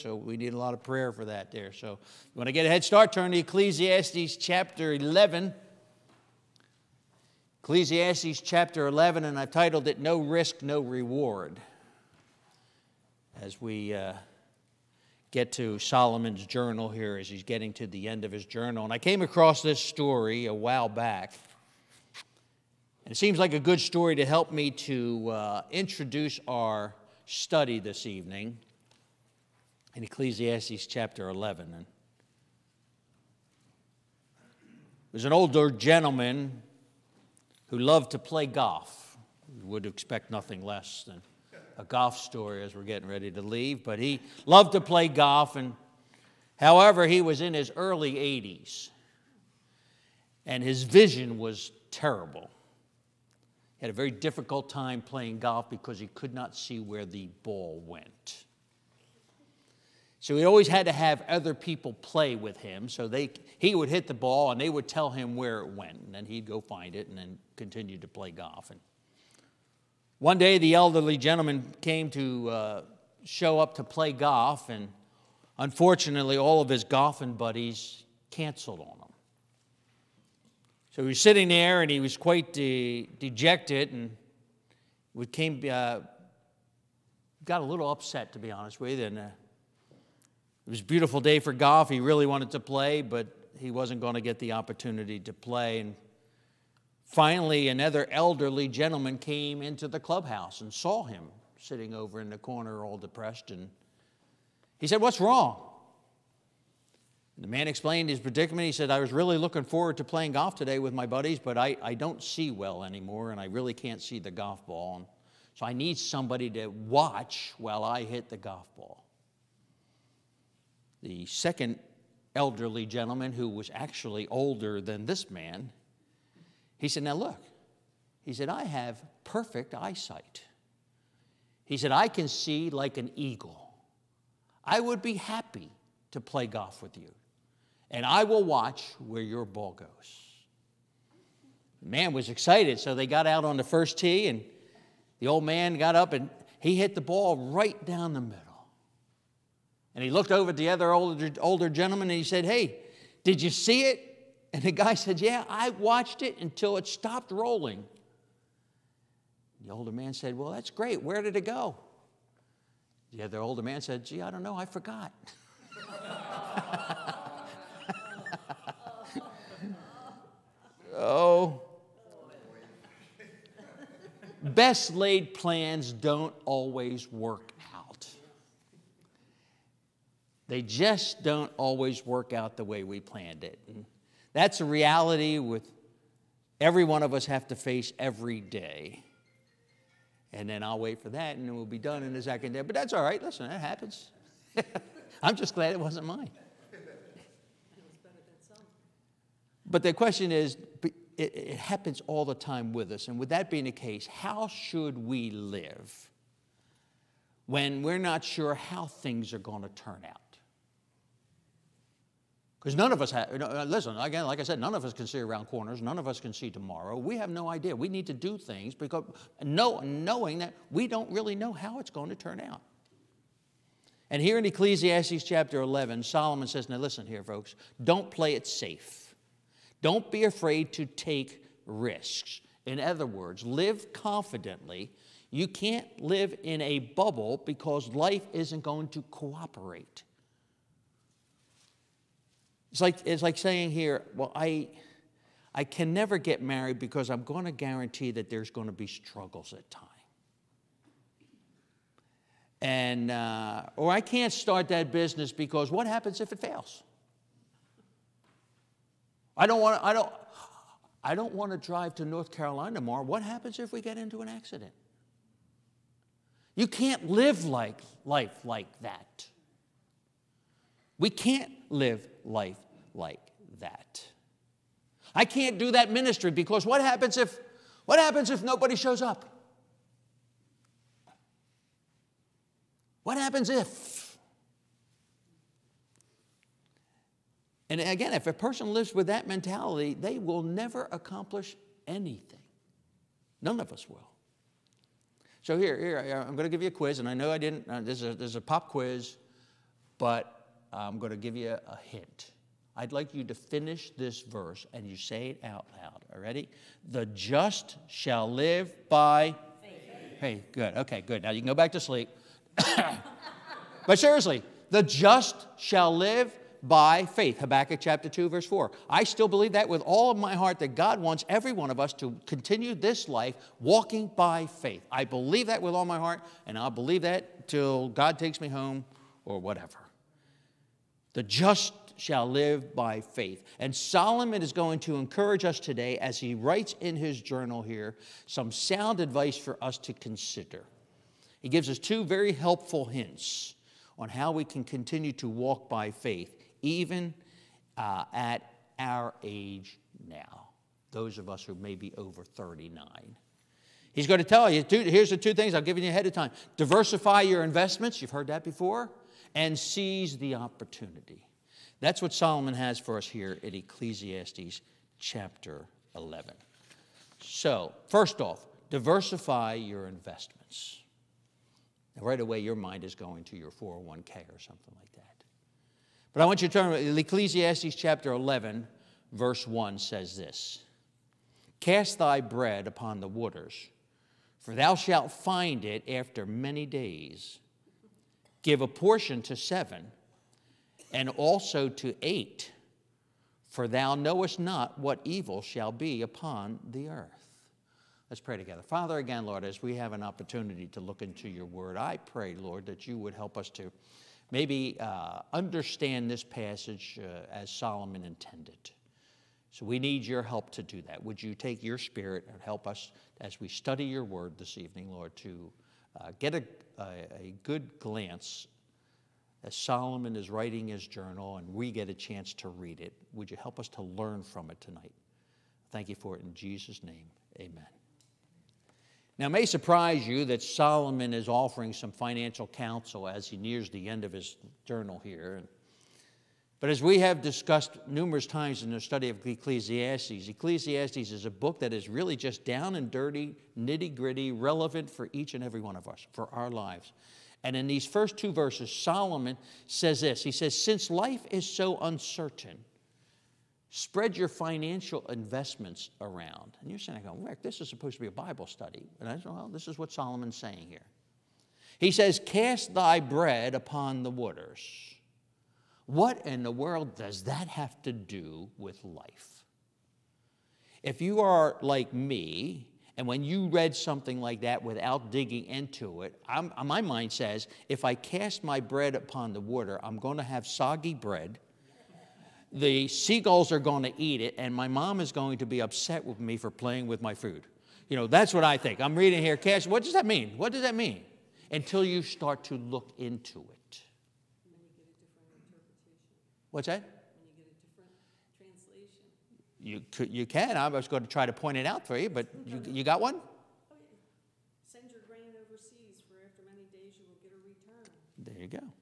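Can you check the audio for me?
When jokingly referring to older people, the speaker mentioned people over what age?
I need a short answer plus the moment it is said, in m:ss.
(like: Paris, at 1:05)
39, at 5:52.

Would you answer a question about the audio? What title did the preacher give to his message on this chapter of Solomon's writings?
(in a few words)
No Risk, No Reward.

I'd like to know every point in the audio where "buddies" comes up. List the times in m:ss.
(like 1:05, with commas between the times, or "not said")
1:17, 1:51.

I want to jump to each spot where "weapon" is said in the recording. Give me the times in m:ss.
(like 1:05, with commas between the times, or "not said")
not said.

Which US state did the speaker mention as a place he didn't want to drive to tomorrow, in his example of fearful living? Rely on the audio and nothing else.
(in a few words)
North Carolina.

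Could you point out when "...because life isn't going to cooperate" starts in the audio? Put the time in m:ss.
3:57.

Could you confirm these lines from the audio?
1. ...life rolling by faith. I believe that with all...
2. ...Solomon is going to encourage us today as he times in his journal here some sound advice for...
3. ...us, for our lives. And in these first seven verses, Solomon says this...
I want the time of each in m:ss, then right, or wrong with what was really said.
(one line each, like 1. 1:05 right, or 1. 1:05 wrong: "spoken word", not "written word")
1. 5:23 wrong: "walking", not "rolling"
2. 5:33 wrong: "writes", not "times"
3. 7:25 wrong: "two", not "seven".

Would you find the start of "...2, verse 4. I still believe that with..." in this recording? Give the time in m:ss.
5:18.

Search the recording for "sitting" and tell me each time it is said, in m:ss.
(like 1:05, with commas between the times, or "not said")
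1:21, 1:41.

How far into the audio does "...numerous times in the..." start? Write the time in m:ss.
7:17.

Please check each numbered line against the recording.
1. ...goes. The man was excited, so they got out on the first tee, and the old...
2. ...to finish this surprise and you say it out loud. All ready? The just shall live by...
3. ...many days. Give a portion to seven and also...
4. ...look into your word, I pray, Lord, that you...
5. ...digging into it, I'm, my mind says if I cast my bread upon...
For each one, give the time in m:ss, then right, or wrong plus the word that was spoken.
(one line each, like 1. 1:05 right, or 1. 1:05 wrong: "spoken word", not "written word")
1. 2:19 right
2. 5:03 wrong: "verse", not "surprise"
3. 6:26 right
4. 6:40 right
5. 7:55 right.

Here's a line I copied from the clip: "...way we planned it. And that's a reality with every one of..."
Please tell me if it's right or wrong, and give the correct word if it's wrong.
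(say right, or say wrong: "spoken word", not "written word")
right.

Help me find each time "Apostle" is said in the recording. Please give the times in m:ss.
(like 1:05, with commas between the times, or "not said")
not said.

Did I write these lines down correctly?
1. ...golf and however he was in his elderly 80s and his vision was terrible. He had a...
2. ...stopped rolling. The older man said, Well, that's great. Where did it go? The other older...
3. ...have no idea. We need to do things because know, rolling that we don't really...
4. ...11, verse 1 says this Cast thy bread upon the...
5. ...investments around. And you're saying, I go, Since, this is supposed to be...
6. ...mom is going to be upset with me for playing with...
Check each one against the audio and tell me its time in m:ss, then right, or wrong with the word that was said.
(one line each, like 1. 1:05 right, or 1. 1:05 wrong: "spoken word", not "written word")
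1. 0:45 wrong: "early", not "elderly"
2. 2:36 right
3. 3:37 wrong: "knowing", not "rolling"
4. 6:18 right
5. 7:35 wrong: "Rick", not "Since"
6. 8:04 right.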